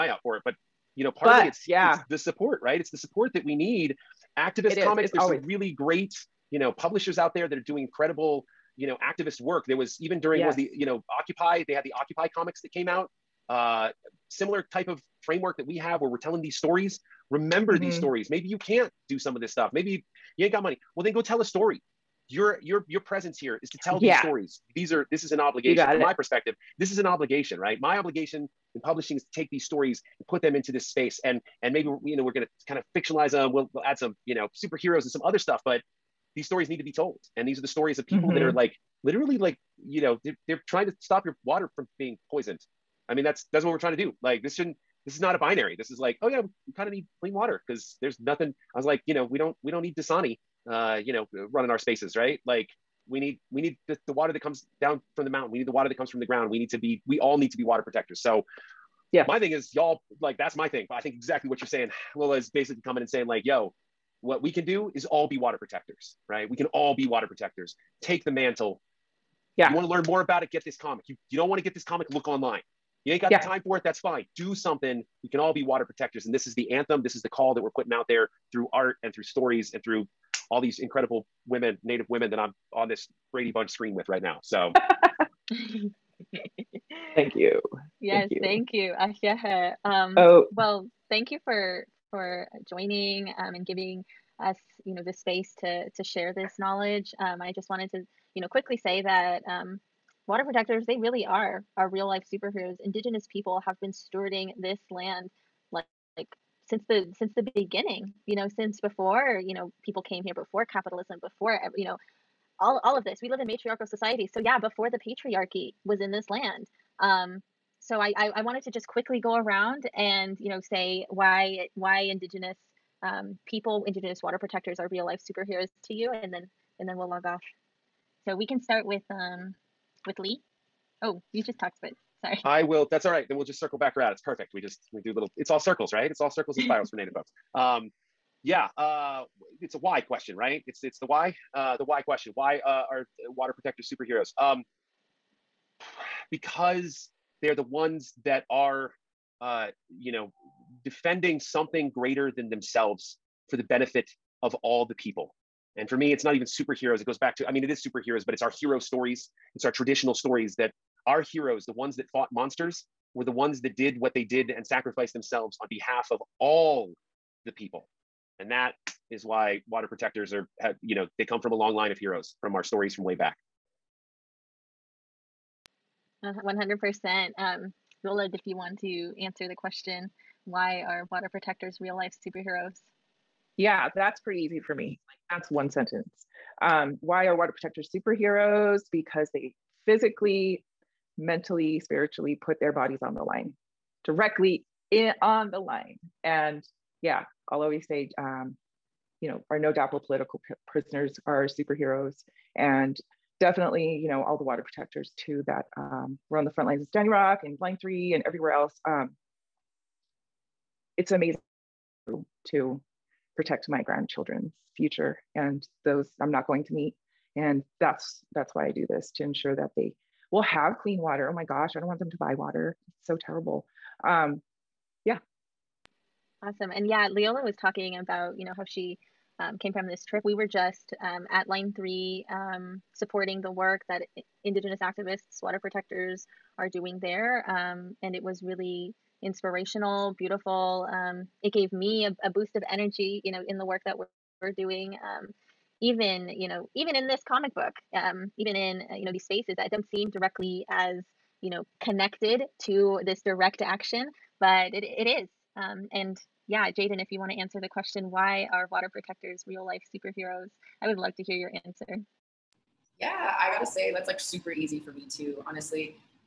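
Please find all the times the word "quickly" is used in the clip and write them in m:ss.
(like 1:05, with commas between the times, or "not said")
1:38, 1:58.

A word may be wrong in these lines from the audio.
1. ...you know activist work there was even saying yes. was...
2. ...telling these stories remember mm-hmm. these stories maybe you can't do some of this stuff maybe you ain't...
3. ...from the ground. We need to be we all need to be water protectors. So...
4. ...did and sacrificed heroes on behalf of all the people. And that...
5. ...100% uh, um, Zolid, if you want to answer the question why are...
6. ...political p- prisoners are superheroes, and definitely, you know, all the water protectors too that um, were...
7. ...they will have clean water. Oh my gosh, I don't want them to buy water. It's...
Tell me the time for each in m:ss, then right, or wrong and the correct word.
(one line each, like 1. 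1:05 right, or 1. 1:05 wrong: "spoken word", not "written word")
1. 0:08 wrong: "during", not "saying"
2. 0:16 right
3. 0:56 right
4. 2:44 wrong: "themselves", not "heroes"
5. 2:56 right
6. 3:20 right
7. 3:39 right.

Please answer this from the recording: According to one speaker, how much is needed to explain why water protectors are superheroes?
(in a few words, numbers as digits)
One sentence.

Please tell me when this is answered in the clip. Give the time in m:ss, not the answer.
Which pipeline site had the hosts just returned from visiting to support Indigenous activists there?
3:51.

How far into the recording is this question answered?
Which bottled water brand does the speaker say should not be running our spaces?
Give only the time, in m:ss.
0:49.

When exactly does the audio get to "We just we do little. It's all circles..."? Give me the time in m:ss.
2:14.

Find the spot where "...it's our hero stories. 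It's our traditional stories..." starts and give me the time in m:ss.
2:38.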